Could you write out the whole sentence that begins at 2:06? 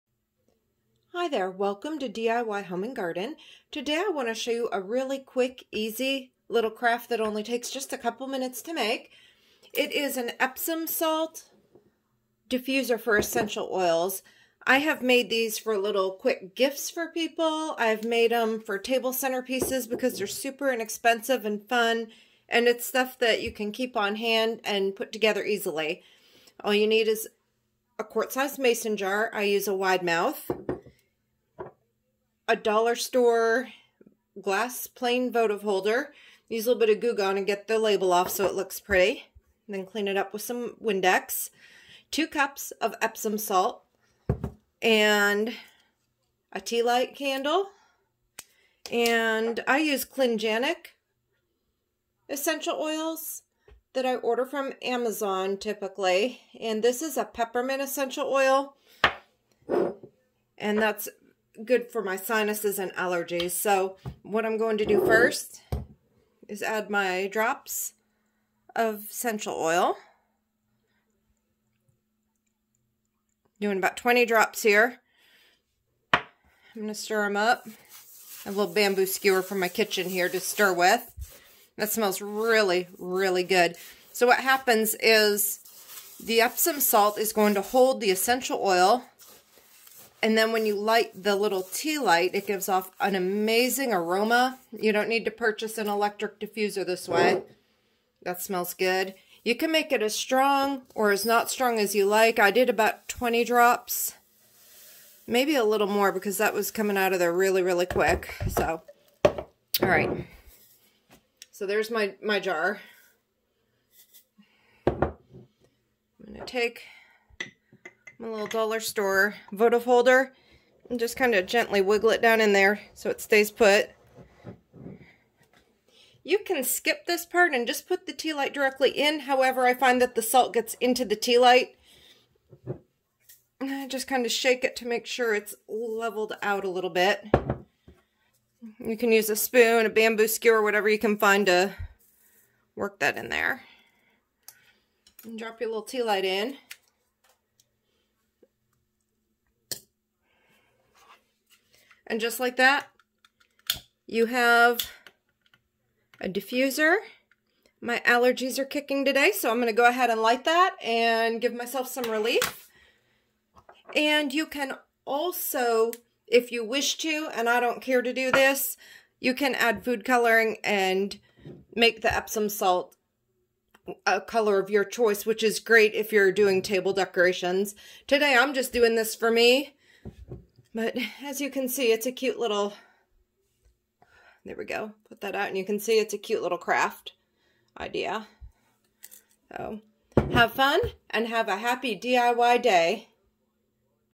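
You can skip this part and just put the tea light directly in.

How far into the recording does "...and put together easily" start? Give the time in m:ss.
0:24.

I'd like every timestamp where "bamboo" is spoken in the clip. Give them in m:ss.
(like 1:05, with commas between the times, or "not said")
1:18, 2:19.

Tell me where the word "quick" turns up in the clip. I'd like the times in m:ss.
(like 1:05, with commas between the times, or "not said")
0:05, 0:16, 1:47.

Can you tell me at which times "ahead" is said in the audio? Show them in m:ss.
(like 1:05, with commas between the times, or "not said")
2:39.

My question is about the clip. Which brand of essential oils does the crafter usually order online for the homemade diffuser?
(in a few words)
Cliganic.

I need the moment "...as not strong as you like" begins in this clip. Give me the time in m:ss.
1:41.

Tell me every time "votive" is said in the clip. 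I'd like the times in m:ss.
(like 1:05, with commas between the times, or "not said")
0:35, 1:59.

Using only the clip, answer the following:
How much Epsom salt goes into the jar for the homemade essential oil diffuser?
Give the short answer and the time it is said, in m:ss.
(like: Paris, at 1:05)
2 cups, at 0:42.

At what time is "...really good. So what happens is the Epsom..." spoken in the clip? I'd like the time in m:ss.
1:22.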